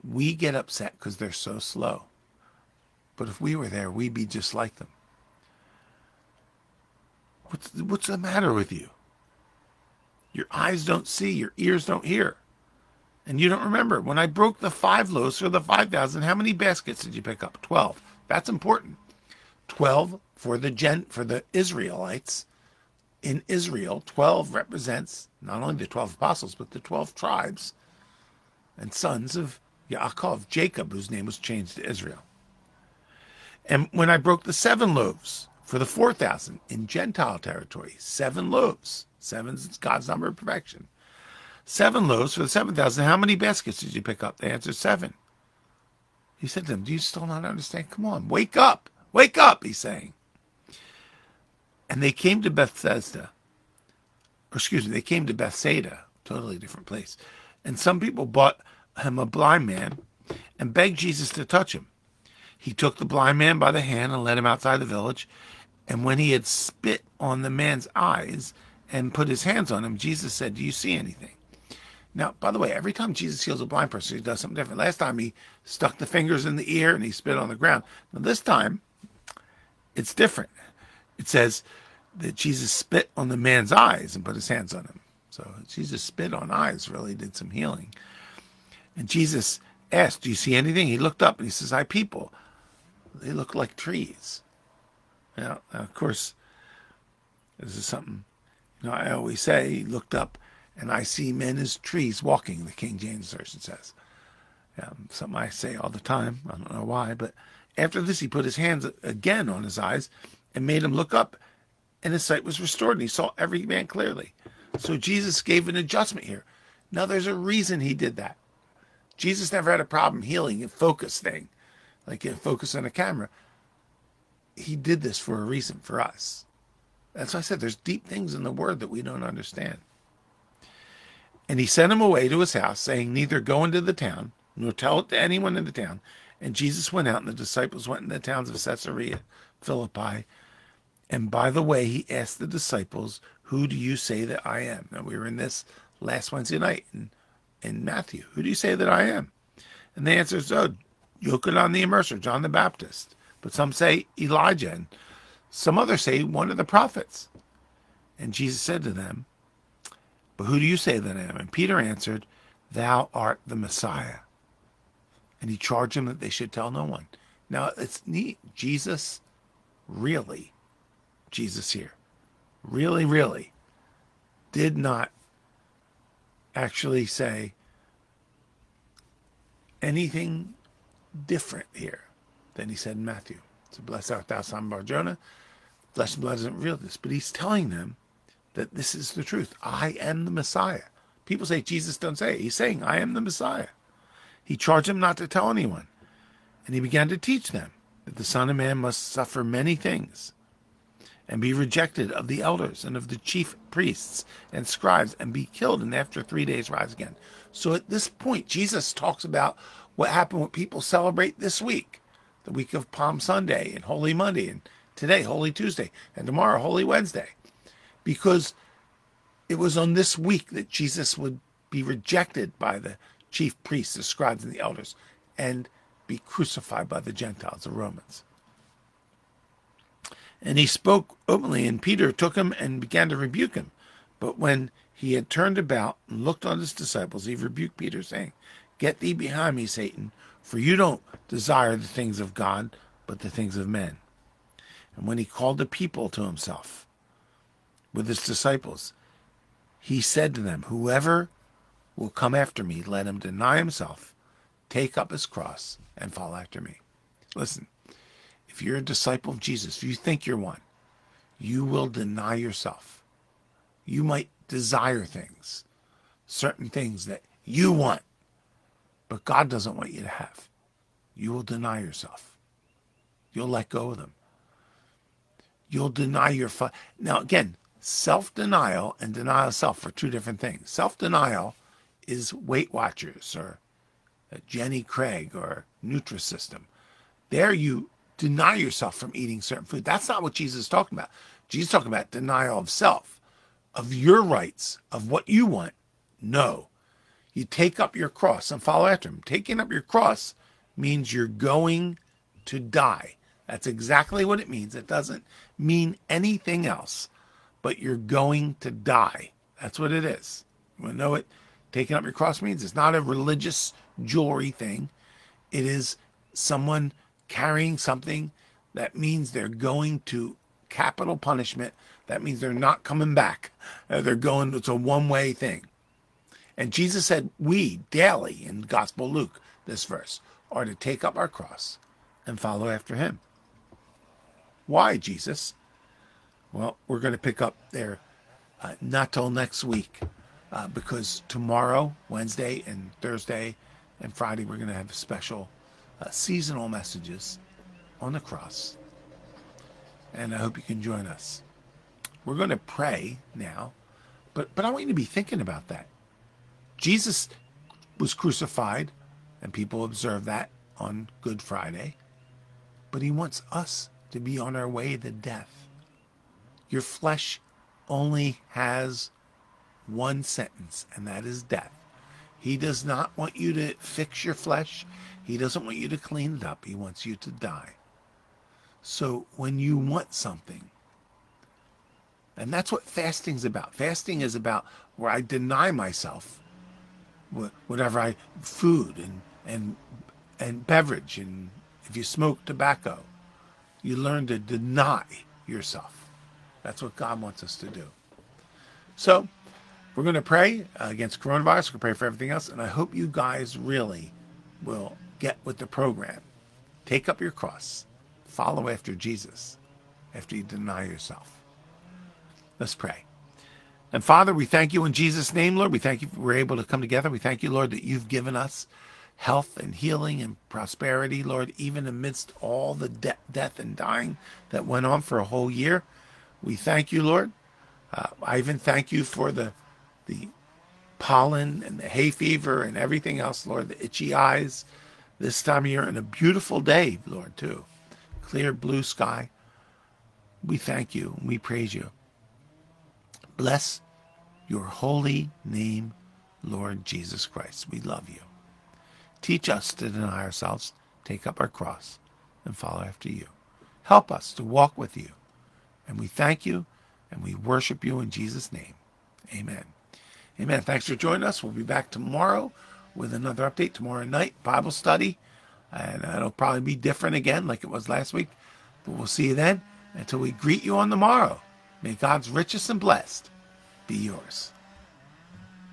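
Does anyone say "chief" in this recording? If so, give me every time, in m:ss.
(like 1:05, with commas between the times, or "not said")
3:23, 3:43.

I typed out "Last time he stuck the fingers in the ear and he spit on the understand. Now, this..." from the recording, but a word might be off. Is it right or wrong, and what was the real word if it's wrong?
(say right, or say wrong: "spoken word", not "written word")
wrong: "ground", not "understand".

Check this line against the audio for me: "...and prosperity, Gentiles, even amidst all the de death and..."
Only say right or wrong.
wrong.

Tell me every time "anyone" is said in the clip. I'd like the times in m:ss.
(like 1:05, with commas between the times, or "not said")
2:15, 3:15.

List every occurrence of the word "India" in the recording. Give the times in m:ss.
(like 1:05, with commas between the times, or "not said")
not said.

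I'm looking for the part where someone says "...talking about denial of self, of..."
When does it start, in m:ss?
4:51.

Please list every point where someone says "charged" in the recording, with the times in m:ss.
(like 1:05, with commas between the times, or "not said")
2:45, 3:14.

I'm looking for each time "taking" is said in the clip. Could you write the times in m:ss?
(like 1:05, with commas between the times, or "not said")
4:59, 5:11.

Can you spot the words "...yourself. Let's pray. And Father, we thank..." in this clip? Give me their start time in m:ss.
6:50.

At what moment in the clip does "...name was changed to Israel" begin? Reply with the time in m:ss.
0:31.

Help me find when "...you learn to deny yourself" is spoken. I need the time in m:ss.
6:33.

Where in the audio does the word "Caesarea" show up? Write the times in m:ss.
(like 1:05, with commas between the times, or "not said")
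2:18.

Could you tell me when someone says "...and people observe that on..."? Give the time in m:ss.
5:59.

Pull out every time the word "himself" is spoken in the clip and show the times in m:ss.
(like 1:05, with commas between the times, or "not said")
4:06, 4:13.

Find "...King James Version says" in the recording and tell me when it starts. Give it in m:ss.
1:42.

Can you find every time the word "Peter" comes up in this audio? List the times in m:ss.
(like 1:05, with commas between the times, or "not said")
2:41, 3:51, 3:57.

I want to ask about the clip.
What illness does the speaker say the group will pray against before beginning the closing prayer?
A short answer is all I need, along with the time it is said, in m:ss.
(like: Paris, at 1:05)
Coronavirus, at 6:41.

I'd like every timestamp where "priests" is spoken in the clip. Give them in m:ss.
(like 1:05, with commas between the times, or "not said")
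3:23, 3:43.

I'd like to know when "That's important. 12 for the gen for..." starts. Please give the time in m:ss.
0:18.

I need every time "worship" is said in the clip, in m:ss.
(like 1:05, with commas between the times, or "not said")
7:37.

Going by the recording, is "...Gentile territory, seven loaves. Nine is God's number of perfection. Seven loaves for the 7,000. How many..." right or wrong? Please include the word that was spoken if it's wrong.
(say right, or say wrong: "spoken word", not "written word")
wrong: "Seven", not "Nine".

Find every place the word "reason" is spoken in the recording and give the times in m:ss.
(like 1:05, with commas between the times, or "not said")
1:57, 2:05.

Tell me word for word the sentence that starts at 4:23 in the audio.
You might desire things, certain things that you want.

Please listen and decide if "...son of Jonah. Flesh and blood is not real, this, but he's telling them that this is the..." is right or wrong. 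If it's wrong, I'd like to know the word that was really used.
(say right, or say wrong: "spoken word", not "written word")
right.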